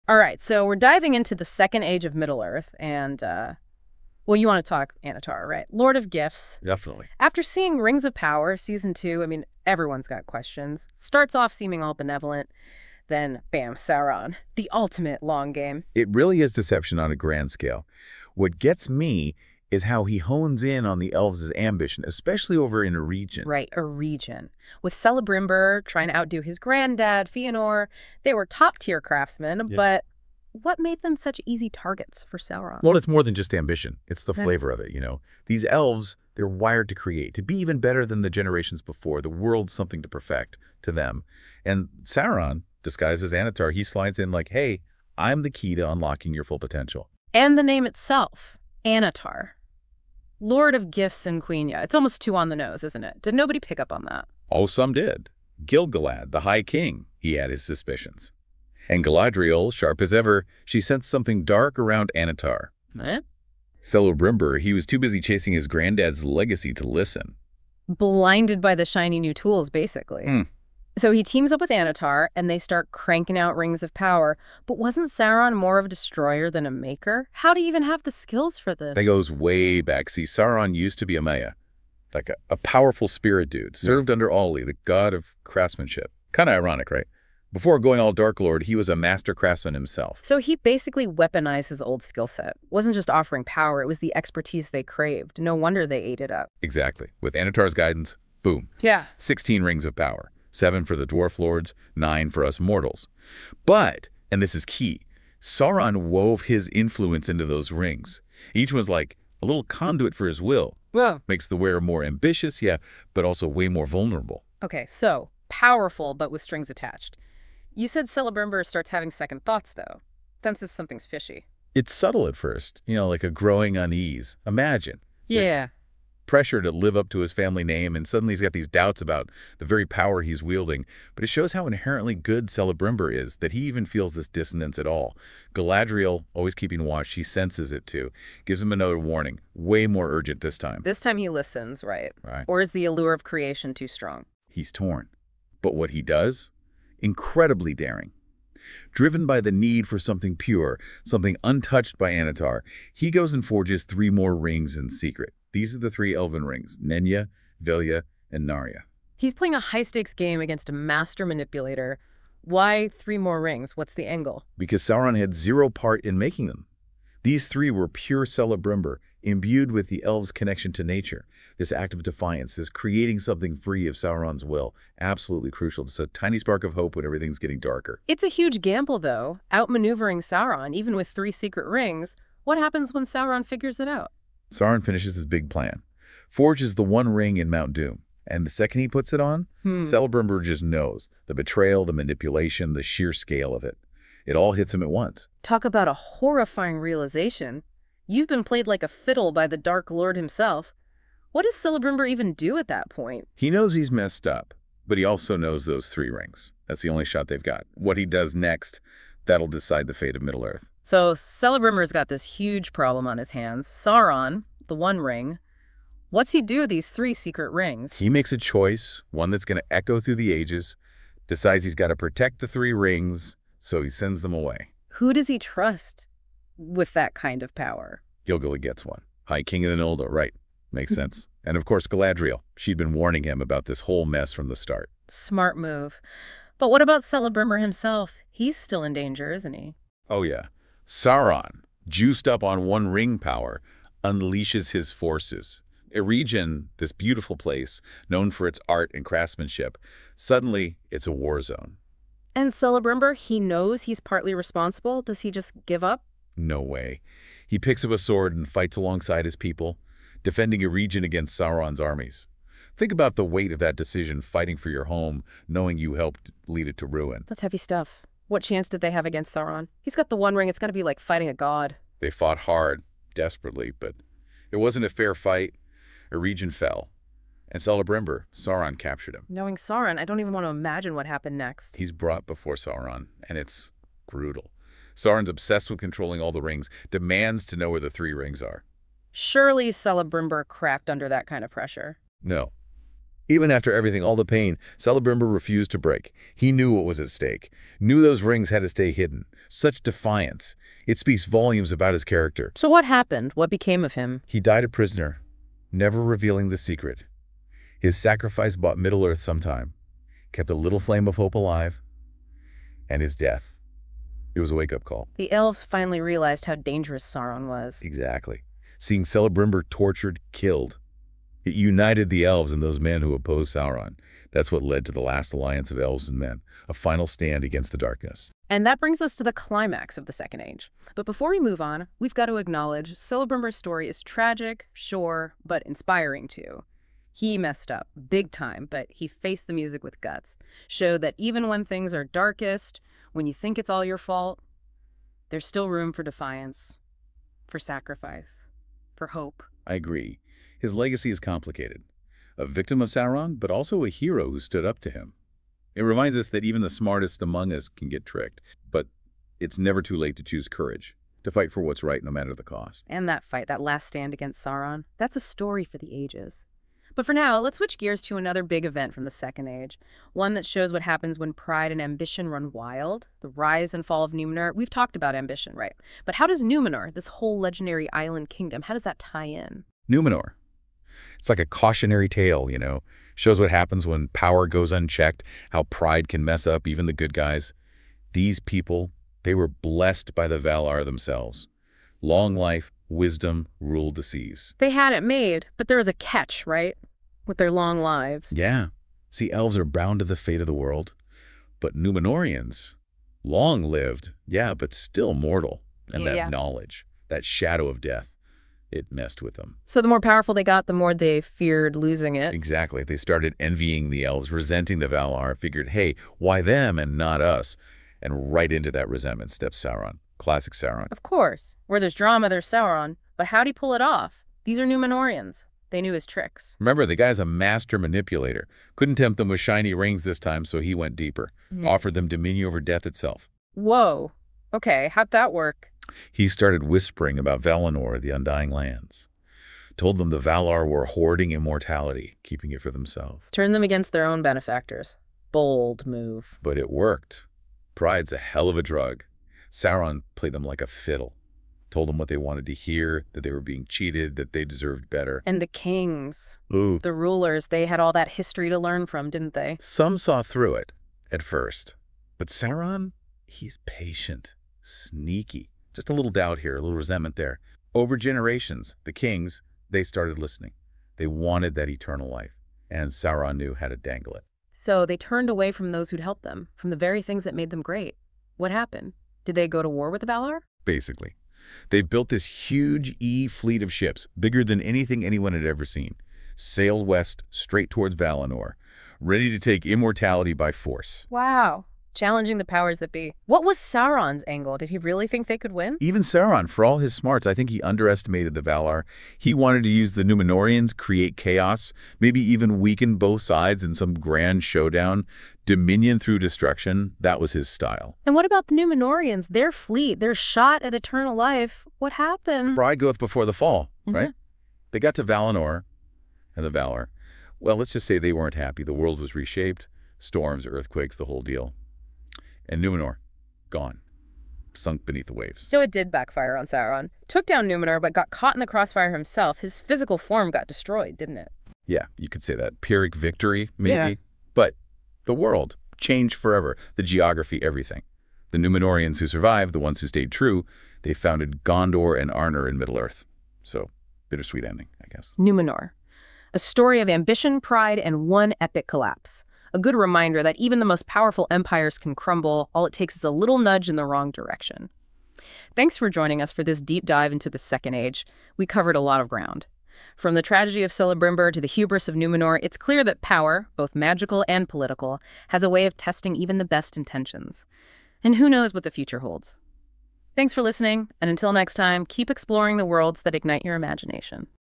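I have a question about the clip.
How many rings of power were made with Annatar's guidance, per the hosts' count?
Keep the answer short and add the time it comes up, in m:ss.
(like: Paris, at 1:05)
16, at 1:39.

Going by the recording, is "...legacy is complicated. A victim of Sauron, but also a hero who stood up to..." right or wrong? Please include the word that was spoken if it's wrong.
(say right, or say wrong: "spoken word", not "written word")
right.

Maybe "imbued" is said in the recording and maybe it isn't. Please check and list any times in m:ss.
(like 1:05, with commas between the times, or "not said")
2:49.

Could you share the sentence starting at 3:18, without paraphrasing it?
You've been played like a fiddle by the Dark Lord himself.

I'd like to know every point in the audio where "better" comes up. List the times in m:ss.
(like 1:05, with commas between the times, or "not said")
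0:37, 7:34.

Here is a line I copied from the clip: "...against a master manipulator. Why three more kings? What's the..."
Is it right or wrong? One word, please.
wrong.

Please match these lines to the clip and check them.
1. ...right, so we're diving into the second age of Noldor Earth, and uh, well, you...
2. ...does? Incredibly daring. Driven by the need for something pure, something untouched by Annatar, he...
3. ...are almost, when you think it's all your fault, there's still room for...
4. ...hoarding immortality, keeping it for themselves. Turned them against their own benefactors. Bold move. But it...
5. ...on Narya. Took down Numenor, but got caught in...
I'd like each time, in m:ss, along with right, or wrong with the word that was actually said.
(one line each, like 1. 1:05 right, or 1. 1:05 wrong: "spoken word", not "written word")
1. 0:00 wrong: "Middle", not "Noldor"
2. 2:26 right
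3. 5:41 wrong: "darkest", not "almost"
4. 7:20 right
5. 8:46 wrong: "Sauron", not "Narya".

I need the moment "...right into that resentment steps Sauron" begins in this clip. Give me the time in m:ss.
6:58.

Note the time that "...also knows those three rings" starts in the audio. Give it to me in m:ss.
3:25.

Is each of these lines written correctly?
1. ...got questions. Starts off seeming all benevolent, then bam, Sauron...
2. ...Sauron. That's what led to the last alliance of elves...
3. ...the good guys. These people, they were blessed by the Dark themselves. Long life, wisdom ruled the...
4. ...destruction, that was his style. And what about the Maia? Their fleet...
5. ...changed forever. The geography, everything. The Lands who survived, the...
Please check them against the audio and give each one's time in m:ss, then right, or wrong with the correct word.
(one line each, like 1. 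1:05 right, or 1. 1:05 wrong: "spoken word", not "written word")
1. 0:10 right
2. 5:23 right
3. 6:26 wrong: "Valar", not "Dark"
4. 8:26 wrong: "Numenorians", not "Maia"
5. 8:55 wrong: "Numenorians", not "Lands".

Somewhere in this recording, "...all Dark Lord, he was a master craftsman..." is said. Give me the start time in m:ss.
1:27.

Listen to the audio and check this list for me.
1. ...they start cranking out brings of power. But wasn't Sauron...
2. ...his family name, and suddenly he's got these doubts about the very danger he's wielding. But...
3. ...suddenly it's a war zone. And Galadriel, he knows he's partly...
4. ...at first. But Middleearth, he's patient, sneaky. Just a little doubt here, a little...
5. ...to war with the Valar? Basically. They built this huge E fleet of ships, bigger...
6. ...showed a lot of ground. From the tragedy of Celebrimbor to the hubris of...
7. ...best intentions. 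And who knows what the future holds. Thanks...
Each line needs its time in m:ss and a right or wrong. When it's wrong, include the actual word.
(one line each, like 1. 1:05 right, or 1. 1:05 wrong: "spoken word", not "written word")
1. 1:12 wrong: "rings", not "brings"
2. 2:07 wrong: "power", not "danger"
3. 4:10 wrong: "Celebrimbor", not "Galadriel"
4. 7:41 wrong: "Sauron", not "Middleearth"
5. 7:59 right
6. 9:18 wrong: "covered", not "showed"
7. 9:26 right.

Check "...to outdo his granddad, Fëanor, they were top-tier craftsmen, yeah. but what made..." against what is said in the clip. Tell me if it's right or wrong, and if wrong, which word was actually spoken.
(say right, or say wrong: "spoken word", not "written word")
right.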